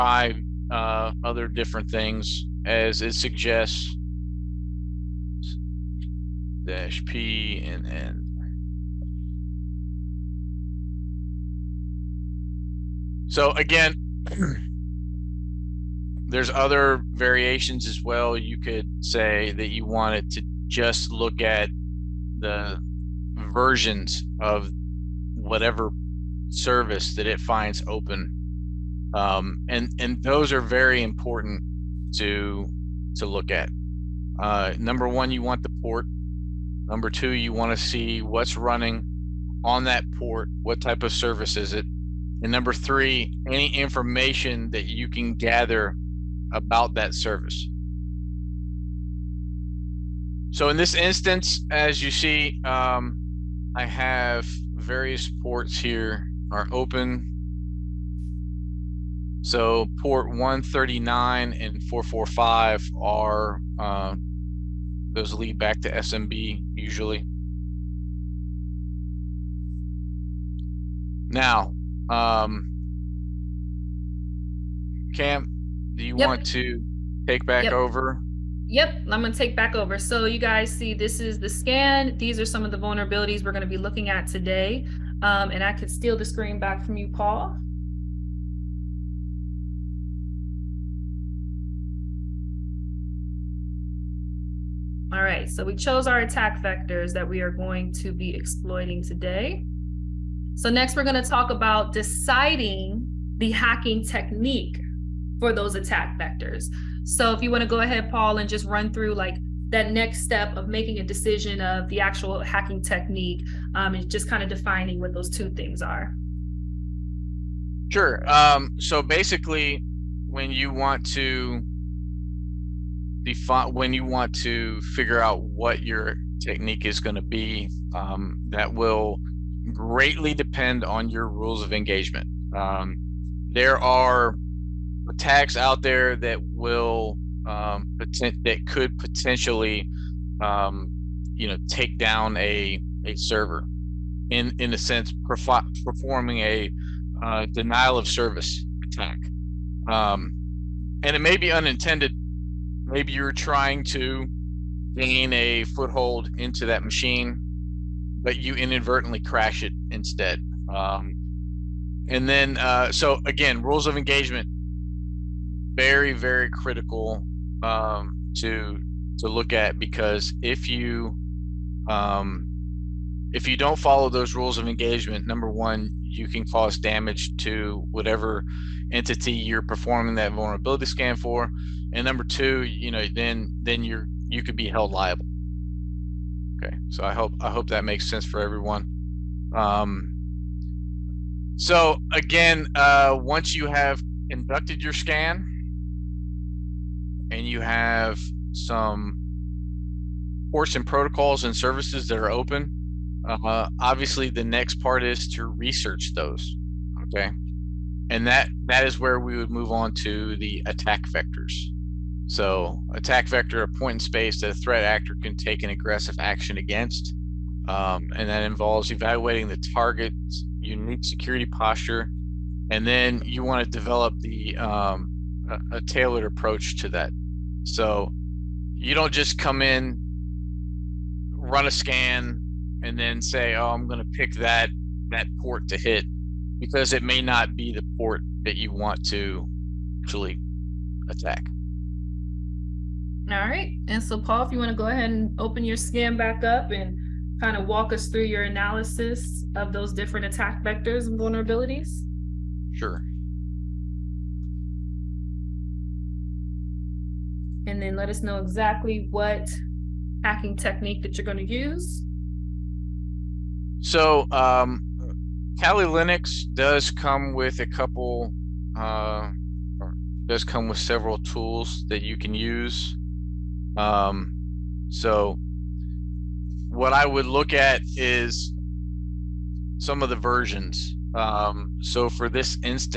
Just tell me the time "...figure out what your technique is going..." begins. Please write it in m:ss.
2:04.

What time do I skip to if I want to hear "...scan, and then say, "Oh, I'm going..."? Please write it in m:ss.
3:51.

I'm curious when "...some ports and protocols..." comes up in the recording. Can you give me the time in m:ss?
3:18.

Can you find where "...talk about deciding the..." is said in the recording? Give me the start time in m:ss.
1:41.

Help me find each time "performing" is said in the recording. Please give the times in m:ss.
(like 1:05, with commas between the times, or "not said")
2:25, 2:59.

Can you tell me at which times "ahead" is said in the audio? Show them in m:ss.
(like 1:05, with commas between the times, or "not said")
1:47, 4:04.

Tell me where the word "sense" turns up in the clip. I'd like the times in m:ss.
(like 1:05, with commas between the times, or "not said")
2:24, 3:08.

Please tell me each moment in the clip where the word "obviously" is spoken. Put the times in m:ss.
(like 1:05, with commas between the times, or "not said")
3:23.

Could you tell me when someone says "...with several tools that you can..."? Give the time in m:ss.
4:30.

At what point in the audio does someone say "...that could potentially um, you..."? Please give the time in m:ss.
2:18.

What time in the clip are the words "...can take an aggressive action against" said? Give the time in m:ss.
3:35.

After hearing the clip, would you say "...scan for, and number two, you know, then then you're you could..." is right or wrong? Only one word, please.
right.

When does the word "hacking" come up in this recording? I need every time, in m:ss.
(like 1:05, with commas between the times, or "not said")
1:43, 1:52, 4:20.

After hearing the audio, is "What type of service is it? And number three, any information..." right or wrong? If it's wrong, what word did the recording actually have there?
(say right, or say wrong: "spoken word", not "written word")
right.